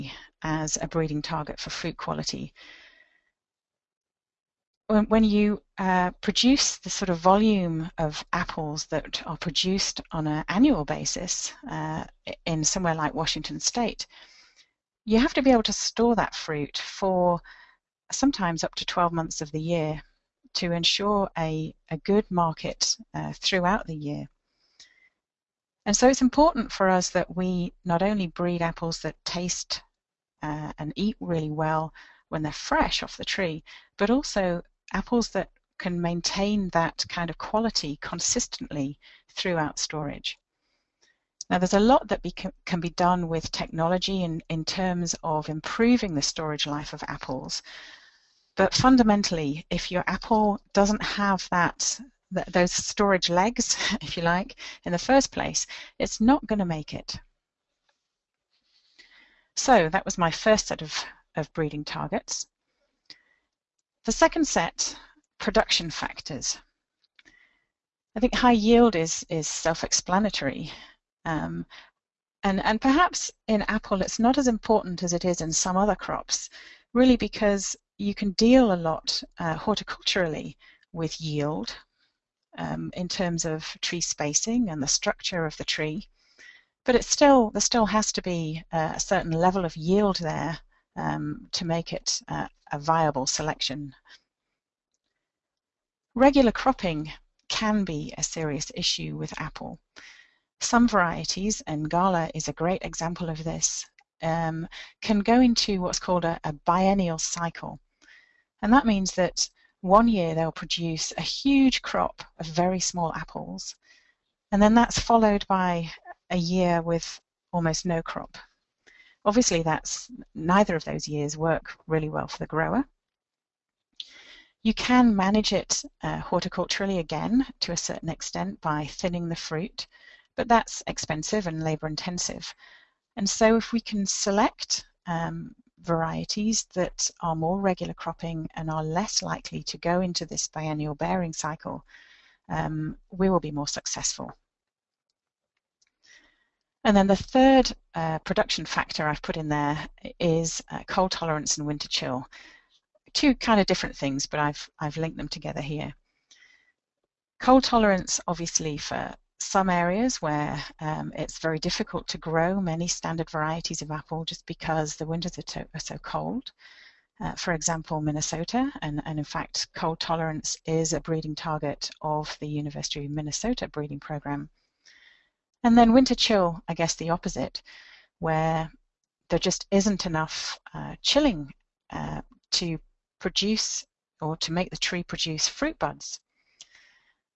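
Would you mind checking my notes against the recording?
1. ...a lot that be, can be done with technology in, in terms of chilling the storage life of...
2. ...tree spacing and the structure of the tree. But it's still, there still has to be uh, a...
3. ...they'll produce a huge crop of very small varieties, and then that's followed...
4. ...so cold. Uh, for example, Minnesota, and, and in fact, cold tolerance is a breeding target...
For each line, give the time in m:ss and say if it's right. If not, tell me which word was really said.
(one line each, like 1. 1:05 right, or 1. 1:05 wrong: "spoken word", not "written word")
1. 0:41 wrong: "improving", not "chilling"
2. 1:23 right
3. 1:50 wrong: "apples", not "varieties"
4. 2:45 right.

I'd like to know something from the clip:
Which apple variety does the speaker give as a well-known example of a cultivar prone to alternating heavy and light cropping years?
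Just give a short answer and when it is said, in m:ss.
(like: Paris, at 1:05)
Gala, at 1:41.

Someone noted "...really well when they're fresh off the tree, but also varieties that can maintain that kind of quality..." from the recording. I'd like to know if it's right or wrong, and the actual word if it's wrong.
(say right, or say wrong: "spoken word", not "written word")
wrong: "apples", not "varieties".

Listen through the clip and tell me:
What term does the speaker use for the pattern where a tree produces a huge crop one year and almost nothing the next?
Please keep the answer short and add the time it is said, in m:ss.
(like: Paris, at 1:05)
biennial cycle, at 1:46.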